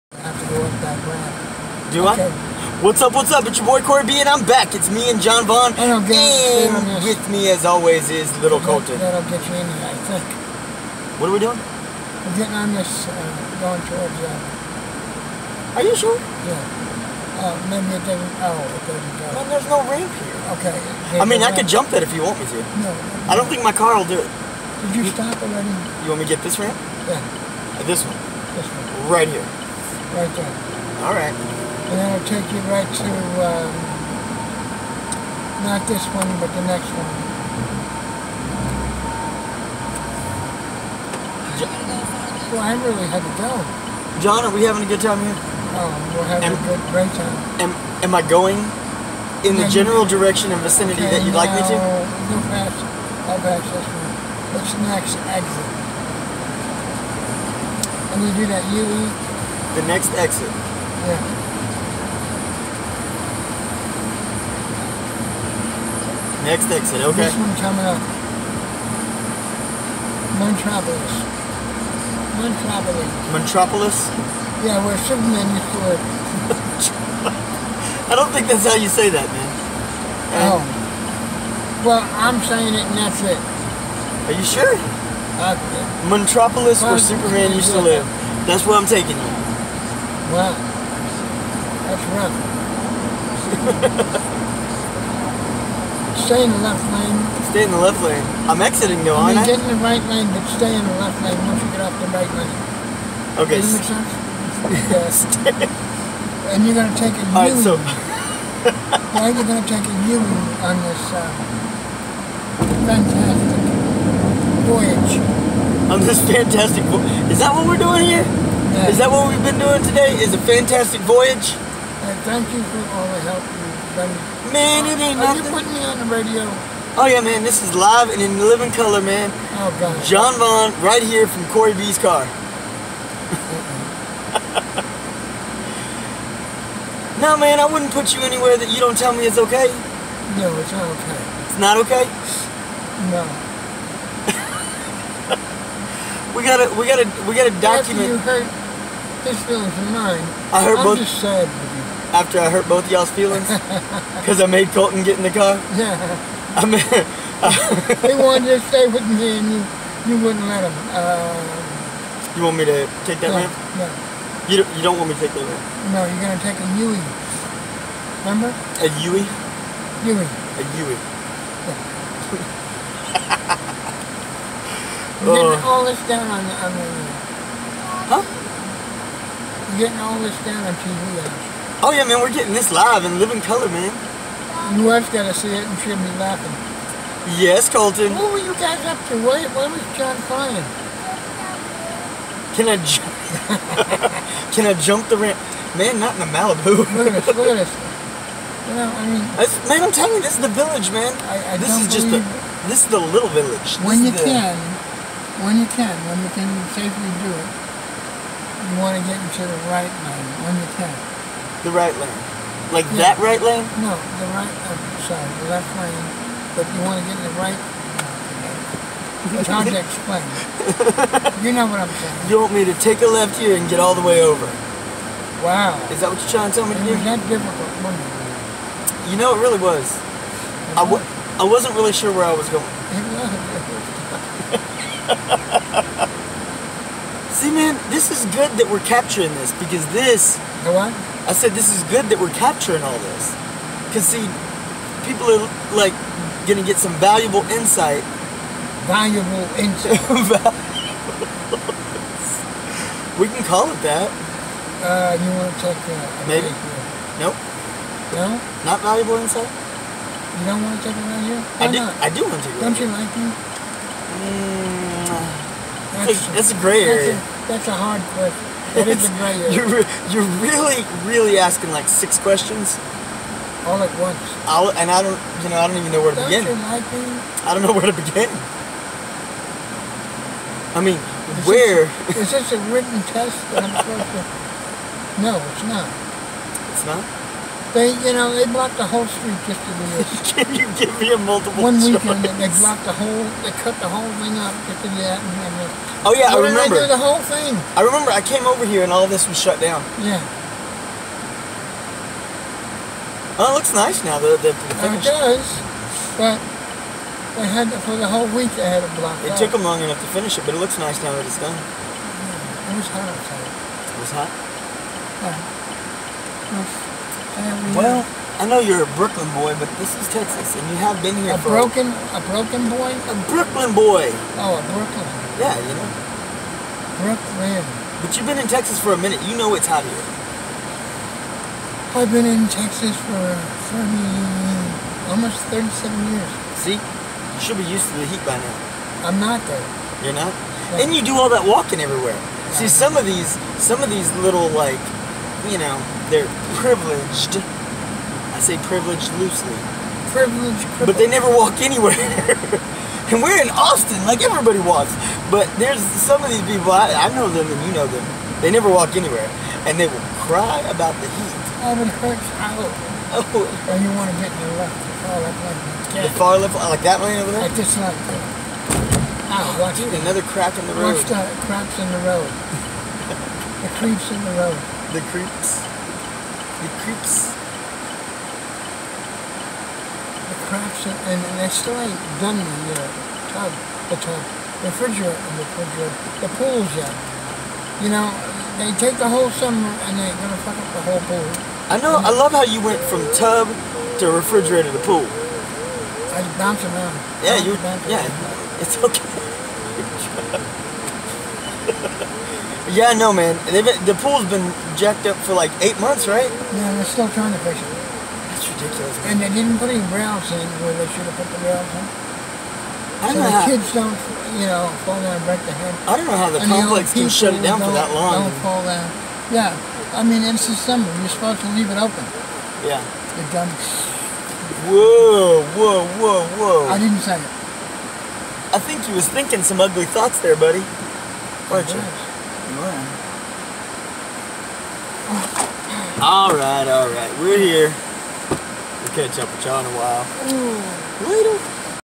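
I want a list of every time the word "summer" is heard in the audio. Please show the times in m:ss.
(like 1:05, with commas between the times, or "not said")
6:29, 7:00.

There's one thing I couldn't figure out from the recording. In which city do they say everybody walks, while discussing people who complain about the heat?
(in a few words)
Austin.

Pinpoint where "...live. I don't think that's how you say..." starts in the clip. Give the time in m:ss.
1:15.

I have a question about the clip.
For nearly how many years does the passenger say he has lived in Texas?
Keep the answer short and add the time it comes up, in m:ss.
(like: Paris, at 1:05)
37, at 5:35.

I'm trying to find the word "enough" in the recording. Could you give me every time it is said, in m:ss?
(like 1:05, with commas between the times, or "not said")
5:09.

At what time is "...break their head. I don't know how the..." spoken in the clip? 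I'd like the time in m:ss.
6:55.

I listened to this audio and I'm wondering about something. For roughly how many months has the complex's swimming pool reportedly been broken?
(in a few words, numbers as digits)
8 months.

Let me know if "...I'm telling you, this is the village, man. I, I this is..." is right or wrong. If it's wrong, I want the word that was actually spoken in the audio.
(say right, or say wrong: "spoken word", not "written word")
right.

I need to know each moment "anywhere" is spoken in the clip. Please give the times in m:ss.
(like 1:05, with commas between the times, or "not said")
2:18, 5:51, 5:58.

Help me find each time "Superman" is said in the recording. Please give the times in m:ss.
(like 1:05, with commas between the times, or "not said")
1:15, 1:26.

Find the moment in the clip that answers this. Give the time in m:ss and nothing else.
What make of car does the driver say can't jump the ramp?
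3:16.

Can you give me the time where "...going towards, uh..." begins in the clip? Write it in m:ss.
0:13.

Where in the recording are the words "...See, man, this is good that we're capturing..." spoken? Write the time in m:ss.
3:57.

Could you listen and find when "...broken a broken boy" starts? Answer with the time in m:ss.
5:21.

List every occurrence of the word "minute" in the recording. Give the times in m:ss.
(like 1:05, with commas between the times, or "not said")
5:28.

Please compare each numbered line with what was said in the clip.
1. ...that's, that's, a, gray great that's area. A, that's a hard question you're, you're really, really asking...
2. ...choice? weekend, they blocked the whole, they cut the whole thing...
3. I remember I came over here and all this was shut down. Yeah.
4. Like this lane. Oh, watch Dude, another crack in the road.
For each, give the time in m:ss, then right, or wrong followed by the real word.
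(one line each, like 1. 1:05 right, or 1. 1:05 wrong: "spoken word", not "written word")
1. 4:26 right
2. 4:51 right
3. 4:57 right
4. 6:07 right.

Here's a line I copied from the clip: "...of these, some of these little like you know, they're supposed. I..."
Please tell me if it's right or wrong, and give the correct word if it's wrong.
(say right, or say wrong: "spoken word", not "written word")
wrong: "privileged", not "supposed".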